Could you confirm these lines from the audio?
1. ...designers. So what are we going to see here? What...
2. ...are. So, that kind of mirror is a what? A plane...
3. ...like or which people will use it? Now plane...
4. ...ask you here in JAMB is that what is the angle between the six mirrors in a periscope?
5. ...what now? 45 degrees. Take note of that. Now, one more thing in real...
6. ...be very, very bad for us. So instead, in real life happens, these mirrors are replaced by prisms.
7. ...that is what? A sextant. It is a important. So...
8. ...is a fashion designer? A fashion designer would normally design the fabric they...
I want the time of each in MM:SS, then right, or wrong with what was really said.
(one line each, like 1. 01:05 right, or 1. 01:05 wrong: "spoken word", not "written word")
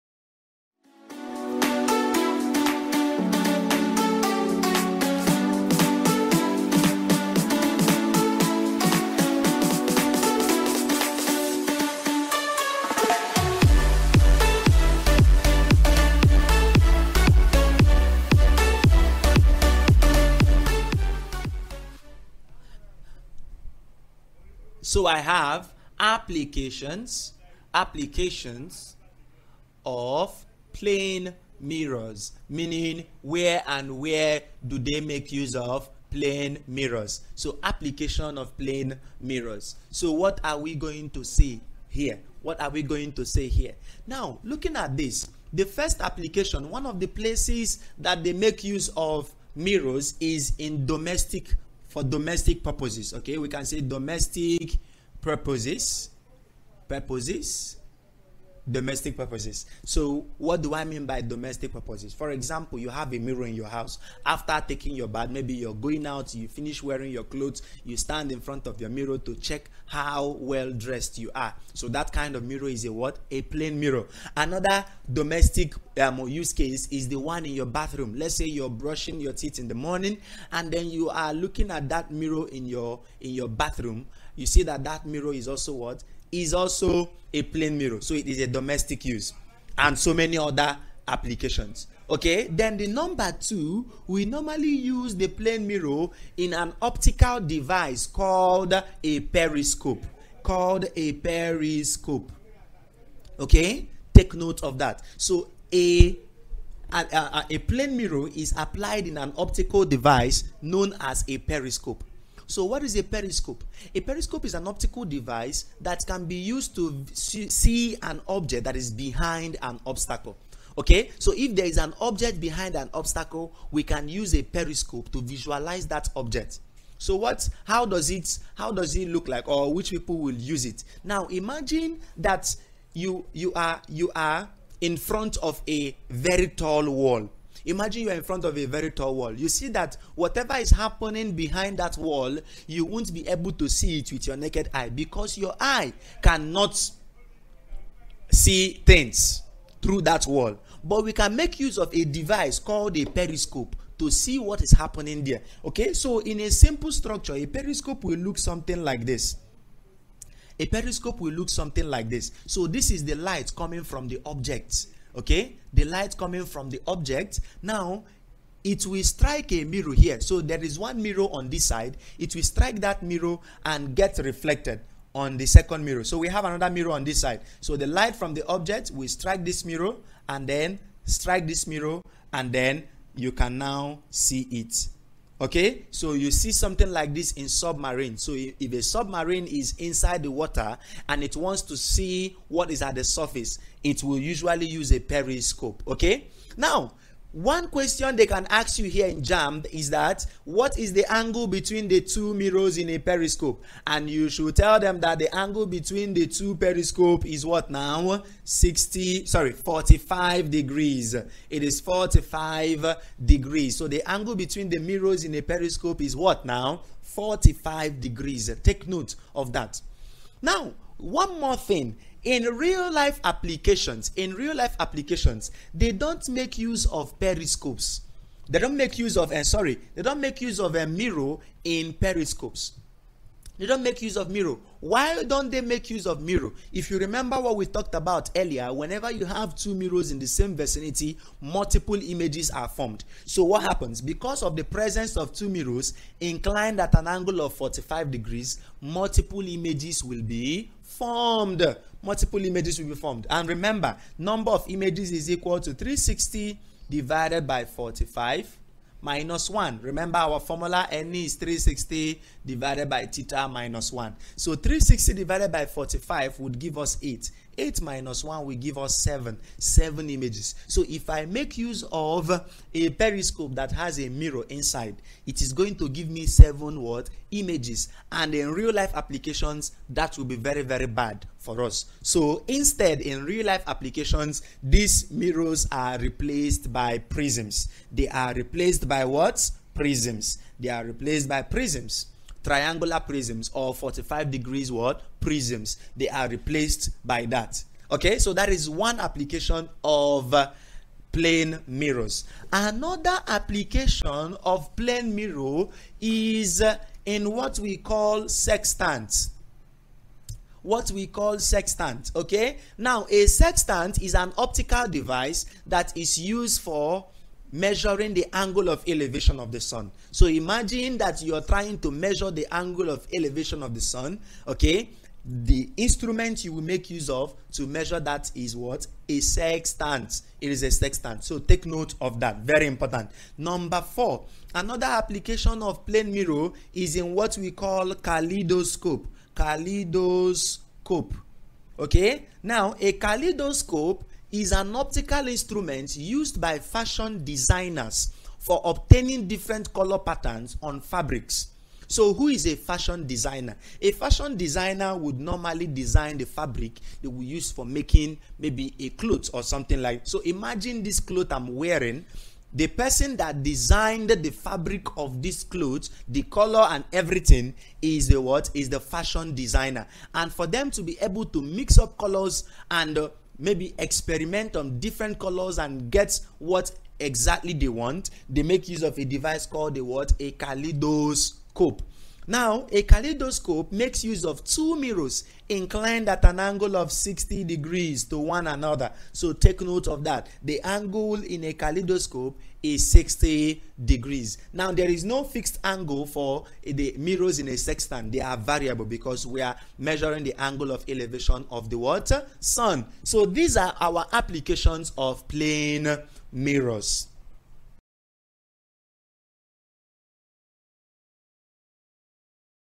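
1. 00:39 wrong: "mirrors", not "designers"
2. 01:11 right
3. 02:09 wrong: "imagine", not "plane"
4. 03:18 wrong: "two", not "six"
5. 03:36 right
6. 04:40 wrong: "applications", not "happens"
7. 05:27 wrong: "sextant", not "important"
8. 05:52 right.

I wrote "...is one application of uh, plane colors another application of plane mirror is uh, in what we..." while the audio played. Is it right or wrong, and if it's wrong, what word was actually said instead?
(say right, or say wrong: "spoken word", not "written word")
wrong: "mirrors", not "colors".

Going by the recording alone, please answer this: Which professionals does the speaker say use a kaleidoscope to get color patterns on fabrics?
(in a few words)
Fashion designers.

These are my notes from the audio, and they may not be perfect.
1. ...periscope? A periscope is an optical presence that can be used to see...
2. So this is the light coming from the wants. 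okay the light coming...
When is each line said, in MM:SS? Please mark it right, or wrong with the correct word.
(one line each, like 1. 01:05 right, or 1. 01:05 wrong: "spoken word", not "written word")
1. 01:53 wrong: "device", not "presence"
2. 02:42 wrong: "objects", not "wants".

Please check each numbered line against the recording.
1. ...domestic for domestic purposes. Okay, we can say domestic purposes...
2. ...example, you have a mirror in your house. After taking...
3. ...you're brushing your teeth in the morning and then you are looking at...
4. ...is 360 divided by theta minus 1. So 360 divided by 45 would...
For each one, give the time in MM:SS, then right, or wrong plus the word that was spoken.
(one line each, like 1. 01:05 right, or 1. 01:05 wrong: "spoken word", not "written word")
1. 00:50 right
2. 01:02 right
3. 01:18 right
4. 04:21 right.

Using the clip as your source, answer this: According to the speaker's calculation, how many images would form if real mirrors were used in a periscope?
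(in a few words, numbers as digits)
7.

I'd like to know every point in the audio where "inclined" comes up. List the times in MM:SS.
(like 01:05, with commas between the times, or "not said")
04:06, 06:25.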